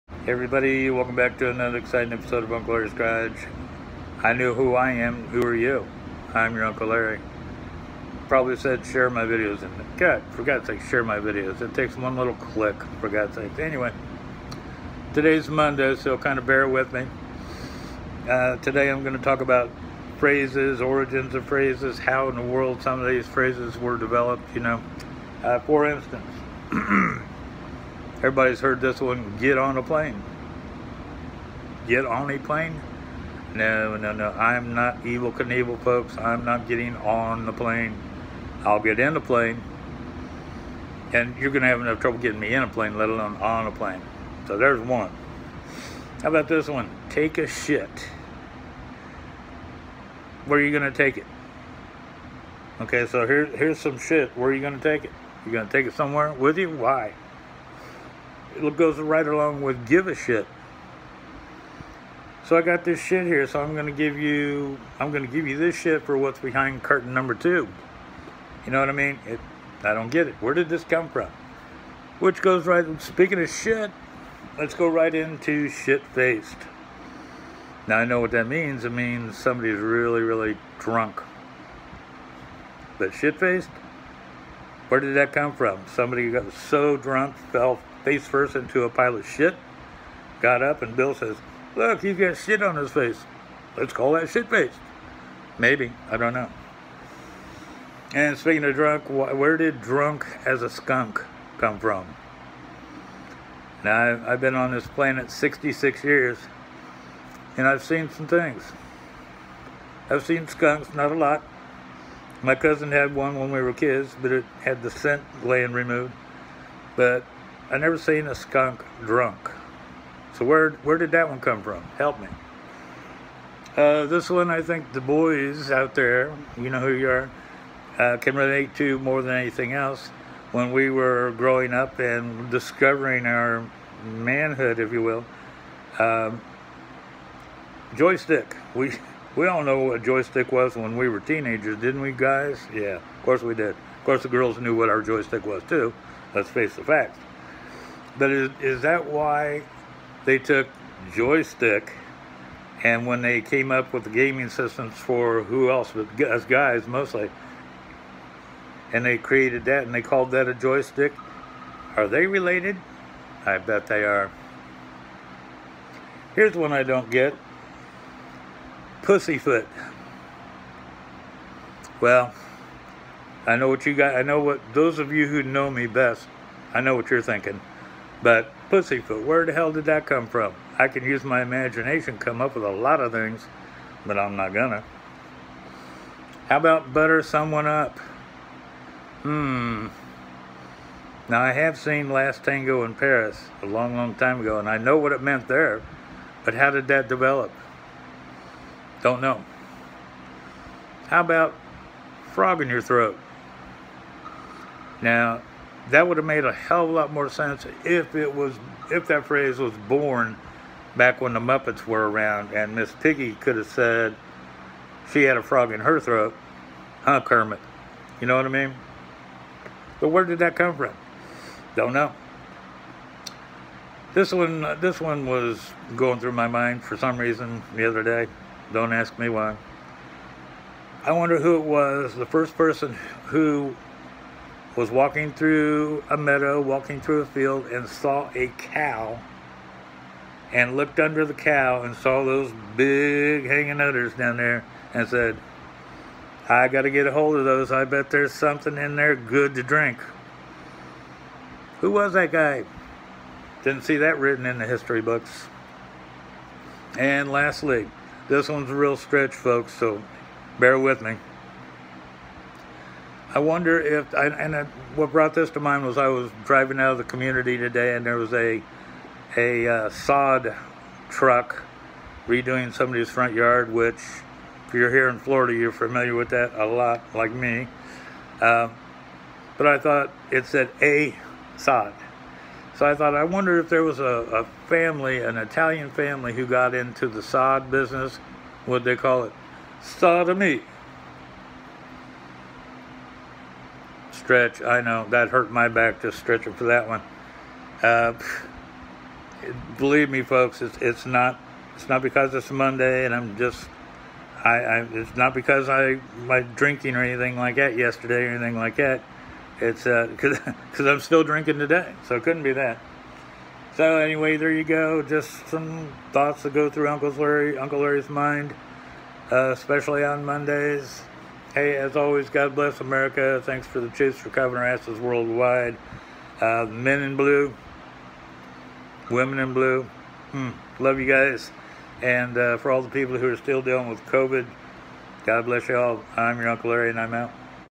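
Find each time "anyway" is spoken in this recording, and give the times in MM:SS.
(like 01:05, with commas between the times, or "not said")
00:13, 05:13.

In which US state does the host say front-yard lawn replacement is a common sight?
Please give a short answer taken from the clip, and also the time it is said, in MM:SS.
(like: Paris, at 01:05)
Florida, at 04:35.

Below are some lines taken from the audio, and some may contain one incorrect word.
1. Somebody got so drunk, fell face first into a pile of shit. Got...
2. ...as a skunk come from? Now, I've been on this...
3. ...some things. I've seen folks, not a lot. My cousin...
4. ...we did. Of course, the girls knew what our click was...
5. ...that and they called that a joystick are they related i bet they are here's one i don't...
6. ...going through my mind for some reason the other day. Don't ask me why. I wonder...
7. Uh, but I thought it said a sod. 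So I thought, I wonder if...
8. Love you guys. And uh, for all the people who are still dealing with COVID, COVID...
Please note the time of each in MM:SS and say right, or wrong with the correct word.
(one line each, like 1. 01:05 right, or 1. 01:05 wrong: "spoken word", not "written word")
1. 01:25 right
2. 01:40 right
3. 01:48 wrong: "skunks", not "folks"
4. 02:23 wrong: "joystick", not "click"
5. 02:39 right
6. 03:45 right
7. 04:38 right
8. 05:30 wrong: "God", not "COVID".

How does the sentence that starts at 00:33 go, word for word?
No, no, no, I'm not Evel Knievel, folks.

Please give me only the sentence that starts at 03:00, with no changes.
I can use my imagination, come up with a lot of things, but I'm not gonna.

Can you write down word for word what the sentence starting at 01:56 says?
But I never seen a skunk drunk.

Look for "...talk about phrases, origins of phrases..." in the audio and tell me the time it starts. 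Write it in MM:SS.
00:19.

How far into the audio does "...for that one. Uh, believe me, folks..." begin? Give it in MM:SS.
04:56.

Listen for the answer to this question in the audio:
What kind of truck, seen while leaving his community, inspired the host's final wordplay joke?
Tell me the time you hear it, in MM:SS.
04:29.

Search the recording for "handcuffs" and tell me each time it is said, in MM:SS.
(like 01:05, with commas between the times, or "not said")
not said.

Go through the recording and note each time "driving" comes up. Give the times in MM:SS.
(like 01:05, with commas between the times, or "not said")
04:26.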